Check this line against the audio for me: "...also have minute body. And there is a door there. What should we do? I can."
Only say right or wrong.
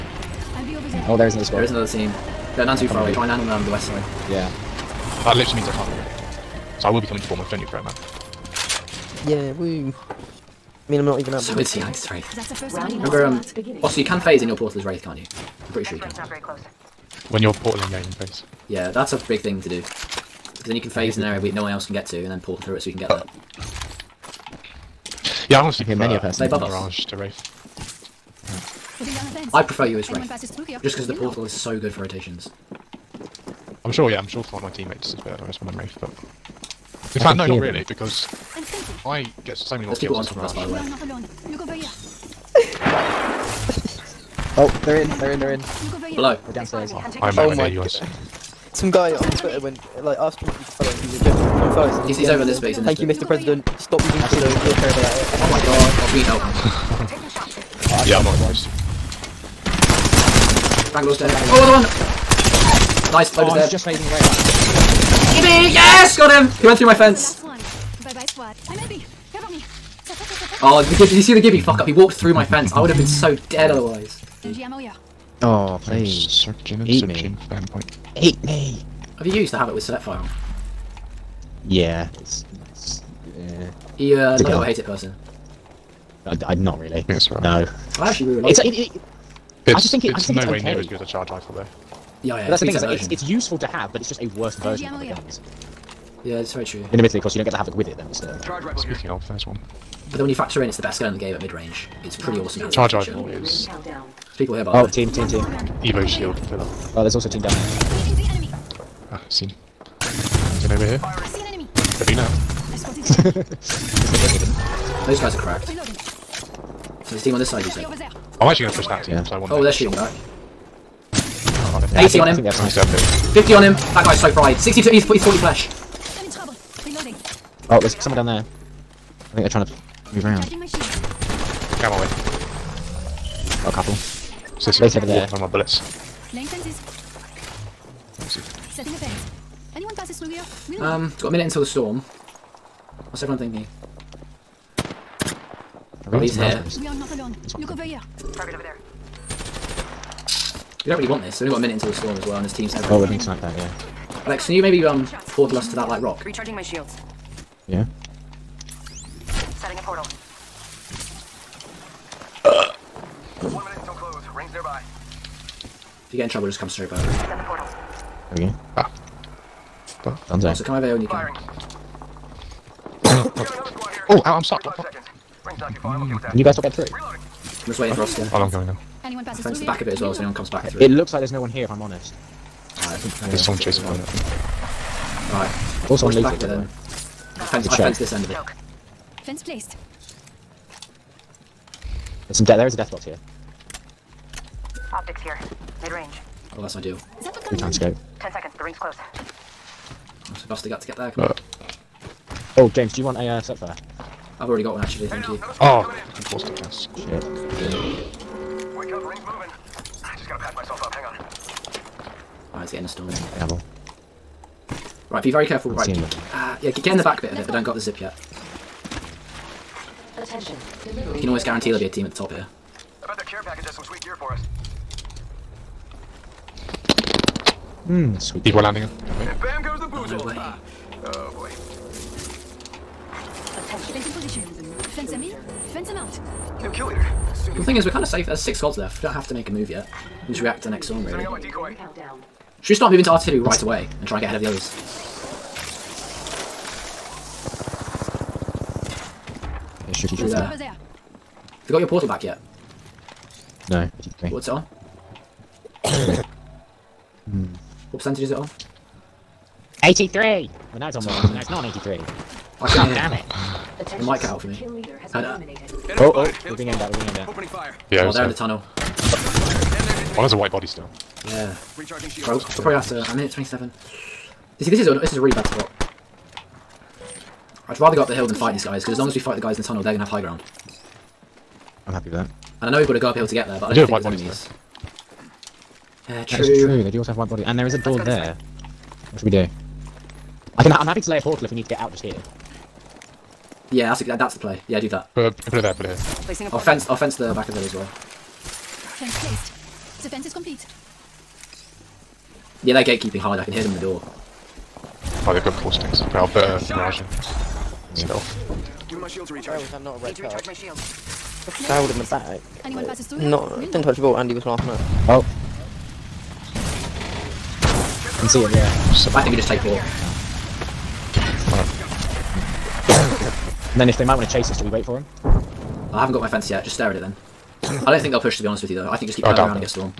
wrong.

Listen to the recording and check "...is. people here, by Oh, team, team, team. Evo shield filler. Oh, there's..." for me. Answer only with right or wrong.
right.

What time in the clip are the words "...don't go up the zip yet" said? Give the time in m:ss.
3:37.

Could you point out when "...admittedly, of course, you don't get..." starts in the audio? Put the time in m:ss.
1:36.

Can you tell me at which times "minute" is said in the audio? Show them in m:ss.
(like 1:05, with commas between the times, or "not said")
2:21, 2:31, 4:33.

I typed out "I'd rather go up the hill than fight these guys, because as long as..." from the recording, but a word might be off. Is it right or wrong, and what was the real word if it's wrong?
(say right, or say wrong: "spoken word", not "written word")
right.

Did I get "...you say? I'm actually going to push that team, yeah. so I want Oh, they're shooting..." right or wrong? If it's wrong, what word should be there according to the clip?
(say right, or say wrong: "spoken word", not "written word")
right.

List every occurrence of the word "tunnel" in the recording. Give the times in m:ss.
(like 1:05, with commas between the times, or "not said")
4:28, 4:39.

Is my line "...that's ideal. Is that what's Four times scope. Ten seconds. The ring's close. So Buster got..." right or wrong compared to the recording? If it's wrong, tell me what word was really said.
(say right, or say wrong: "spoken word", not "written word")
wrong: "Three", not "Four".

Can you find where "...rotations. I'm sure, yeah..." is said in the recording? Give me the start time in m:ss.
0:32.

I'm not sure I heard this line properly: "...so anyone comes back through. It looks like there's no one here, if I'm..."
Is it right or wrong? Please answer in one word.
right.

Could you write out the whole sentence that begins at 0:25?
Yeah, I honestly I hear many a person.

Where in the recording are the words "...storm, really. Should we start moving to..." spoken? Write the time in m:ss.
4:00.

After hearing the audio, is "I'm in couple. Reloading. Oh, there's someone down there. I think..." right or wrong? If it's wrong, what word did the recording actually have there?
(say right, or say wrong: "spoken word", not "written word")
wrong: "trouble", not "couple".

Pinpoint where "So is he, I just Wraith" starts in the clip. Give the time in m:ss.
0:11.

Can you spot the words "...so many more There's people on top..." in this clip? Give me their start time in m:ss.
0:39.